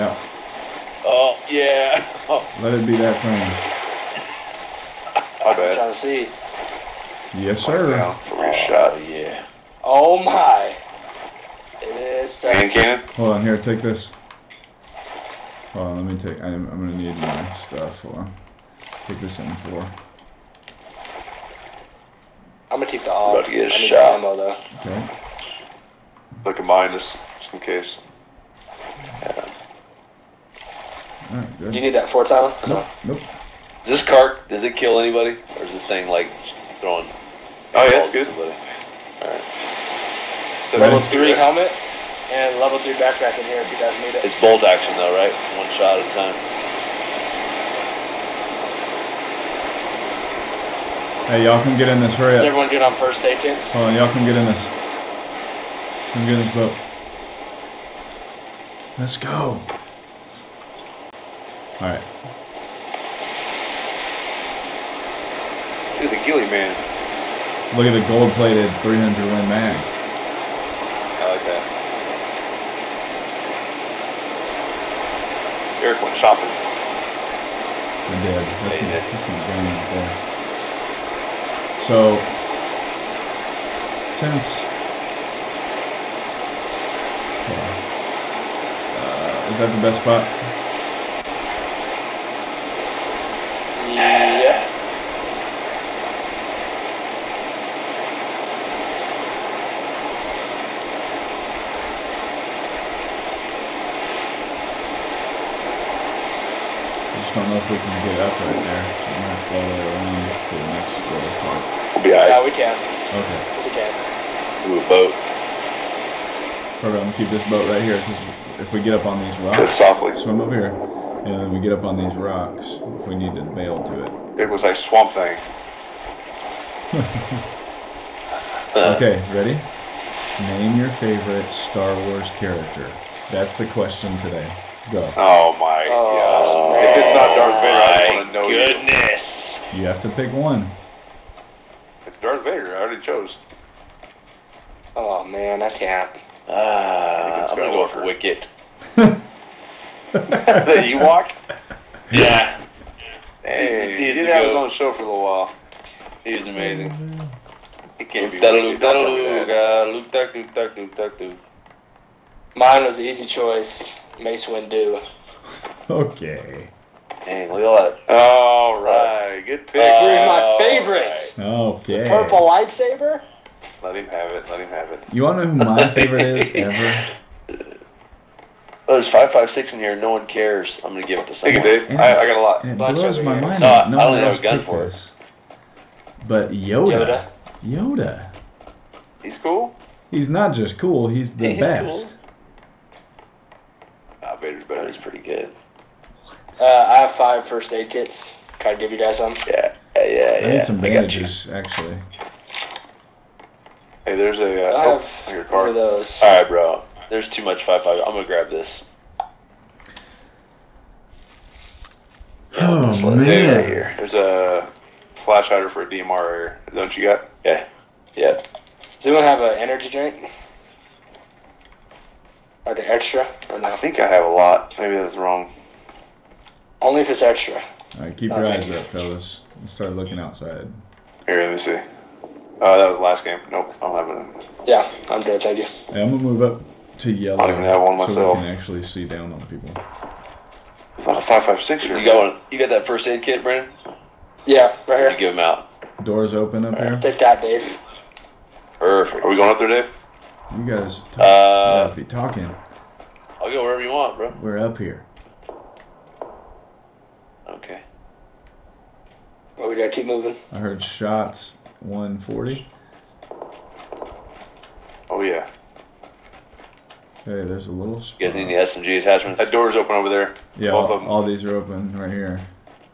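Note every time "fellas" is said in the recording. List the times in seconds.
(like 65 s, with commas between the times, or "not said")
228 s.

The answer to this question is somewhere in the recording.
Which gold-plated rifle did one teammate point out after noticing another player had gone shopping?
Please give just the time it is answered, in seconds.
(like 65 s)
68 s.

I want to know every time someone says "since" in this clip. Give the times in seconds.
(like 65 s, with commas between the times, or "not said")
84 s.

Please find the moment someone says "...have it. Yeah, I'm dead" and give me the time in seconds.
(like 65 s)
234 s.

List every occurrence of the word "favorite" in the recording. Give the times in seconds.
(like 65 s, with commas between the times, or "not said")
130 s, 170 s, 175 s.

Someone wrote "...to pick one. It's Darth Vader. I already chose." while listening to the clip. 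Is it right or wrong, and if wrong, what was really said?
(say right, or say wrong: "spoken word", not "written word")
right.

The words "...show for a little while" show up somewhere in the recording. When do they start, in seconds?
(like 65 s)
154 s.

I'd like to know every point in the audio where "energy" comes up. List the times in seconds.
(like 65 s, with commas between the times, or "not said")
219 s.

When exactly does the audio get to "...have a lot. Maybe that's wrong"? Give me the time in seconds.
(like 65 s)
224 s.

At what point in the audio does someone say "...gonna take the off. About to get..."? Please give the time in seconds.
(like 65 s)
22 s.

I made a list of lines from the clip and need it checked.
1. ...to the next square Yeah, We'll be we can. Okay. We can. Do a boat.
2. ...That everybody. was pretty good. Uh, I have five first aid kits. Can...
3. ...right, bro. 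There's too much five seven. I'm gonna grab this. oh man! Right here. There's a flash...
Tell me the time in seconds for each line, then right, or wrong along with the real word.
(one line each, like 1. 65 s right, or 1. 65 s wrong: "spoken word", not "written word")
1. 110 s right
2. 194 s right
3. 206 s wrong: "five", not "seven".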